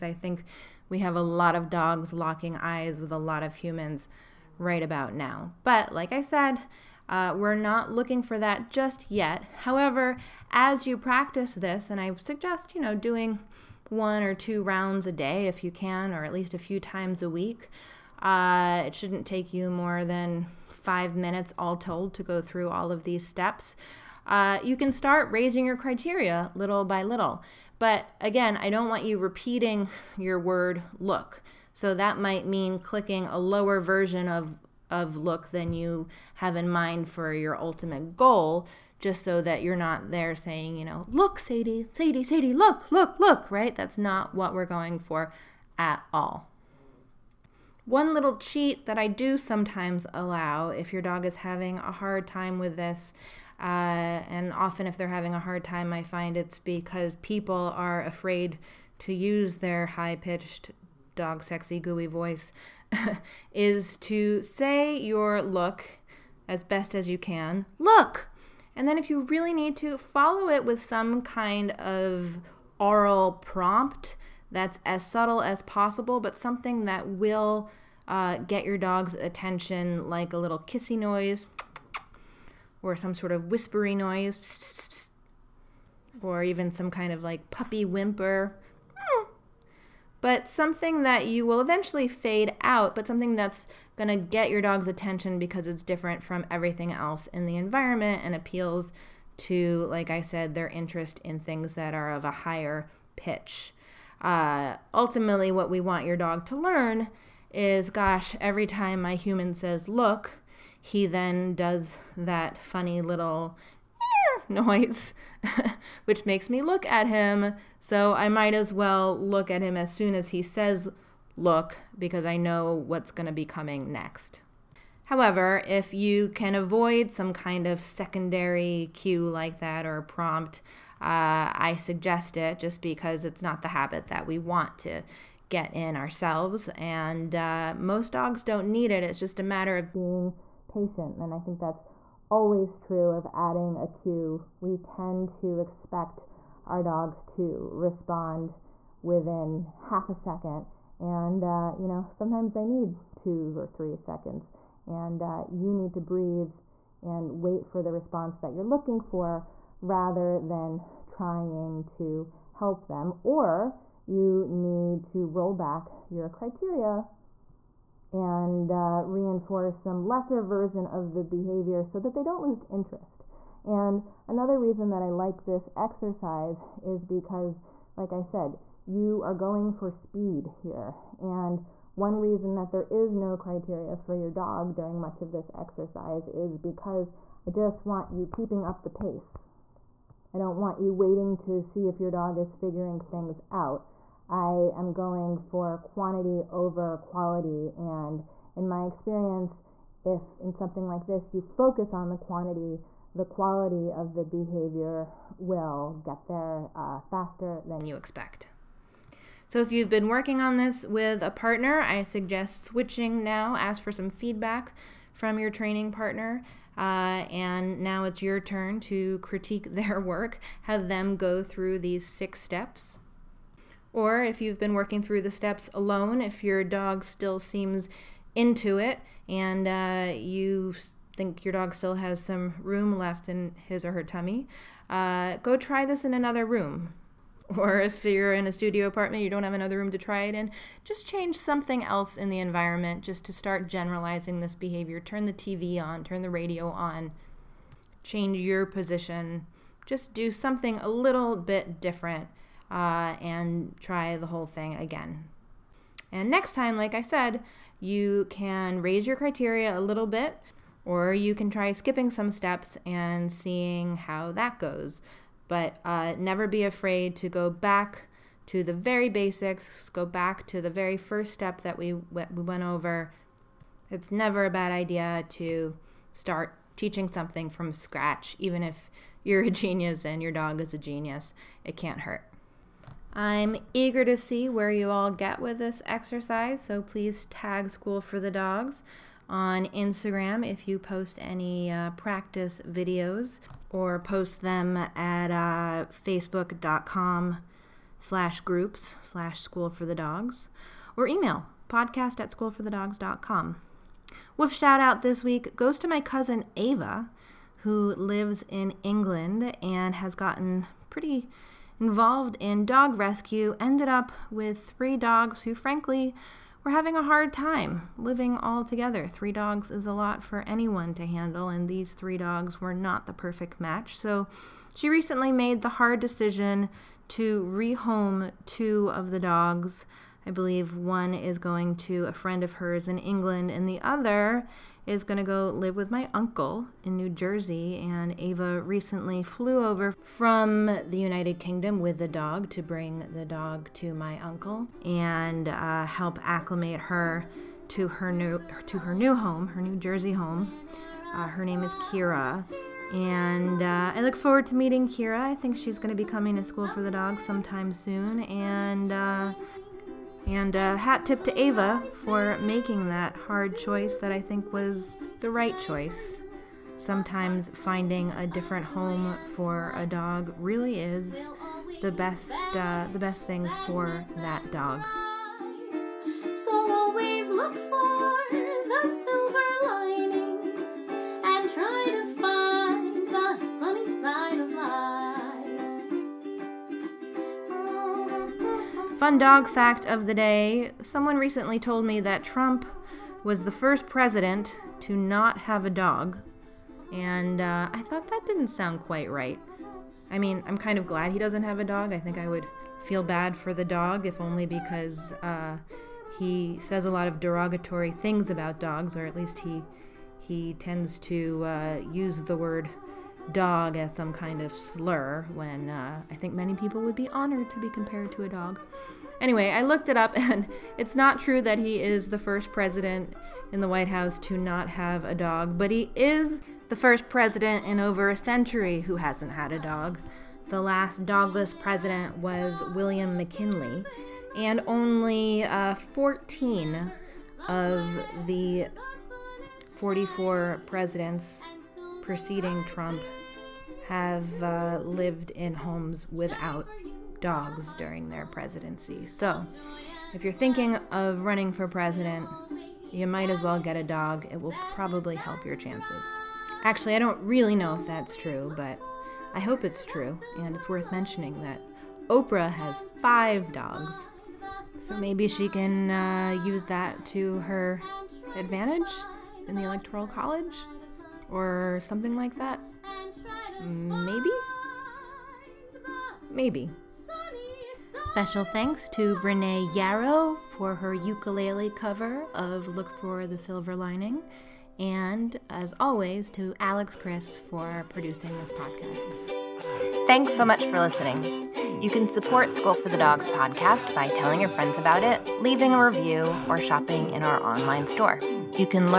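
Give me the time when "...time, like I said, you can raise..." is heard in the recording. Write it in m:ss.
4:16.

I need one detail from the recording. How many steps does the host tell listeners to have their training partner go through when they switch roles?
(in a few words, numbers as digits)
6.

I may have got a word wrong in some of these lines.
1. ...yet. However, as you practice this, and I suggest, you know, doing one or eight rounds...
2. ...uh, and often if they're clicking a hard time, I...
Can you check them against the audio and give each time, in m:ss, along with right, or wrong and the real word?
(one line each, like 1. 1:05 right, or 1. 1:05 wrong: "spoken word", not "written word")
1. 0:09 wrong: "two", not "eight"
2. 0:53 wrong: "having", not "clicking".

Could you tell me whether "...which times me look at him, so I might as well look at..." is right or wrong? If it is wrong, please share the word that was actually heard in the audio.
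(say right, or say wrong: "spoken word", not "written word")
wrong: "makes", not "times".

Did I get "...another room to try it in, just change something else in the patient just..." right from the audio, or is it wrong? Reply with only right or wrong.
wrong.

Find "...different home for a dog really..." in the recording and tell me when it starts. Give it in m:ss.
6:08.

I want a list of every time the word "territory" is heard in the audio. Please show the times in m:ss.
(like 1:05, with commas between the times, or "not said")
not said.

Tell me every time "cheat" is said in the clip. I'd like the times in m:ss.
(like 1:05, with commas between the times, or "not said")
0:48.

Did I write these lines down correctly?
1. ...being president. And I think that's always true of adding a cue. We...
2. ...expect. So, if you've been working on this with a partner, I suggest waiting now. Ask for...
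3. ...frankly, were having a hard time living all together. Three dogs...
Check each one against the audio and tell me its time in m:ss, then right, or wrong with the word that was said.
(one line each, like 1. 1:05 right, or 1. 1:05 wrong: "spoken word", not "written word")
1. 2:19 wrong: "patient", not "president"
2. 3:27 wrong: "switching", not "waiting"
3. 5:15 right.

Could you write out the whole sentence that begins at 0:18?
Uh, it shouldn't take you more than five minutes all told to go through all of these steps.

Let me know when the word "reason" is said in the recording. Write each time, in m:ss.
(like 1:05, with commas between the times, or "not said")
2:54, 3:02.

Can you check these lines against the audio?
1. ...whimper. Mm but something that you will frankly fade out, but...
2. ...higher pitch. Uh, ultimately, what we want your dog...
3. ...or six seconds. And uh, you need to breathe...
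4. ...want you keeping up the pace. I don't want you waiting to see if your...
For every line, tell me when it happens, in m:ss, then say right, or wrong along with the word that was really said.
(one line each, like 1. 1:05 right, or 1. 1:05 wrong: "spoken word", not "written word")
1. 1:27 wrong: "eventually", not "frankly"
2. 1:42 right
3. 2:33 wrong: "three", not "six"
4. 3:07 right.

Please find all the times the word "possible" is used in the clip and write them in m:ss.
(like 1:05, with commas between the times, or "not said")
1:15.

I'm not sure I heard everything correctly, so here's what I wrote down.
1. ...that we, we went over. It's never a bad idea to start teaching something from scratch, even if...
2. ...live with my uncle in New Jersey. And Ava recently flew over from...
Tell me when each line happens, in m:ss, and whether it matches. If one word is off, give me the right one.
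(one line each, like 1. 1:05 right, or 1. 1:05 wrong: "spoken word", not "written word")
1. 4:31 right
2. 5:35 right.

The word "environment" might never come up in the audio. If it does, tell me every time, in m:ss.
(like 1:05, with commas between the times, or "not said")
1:37, 4:02.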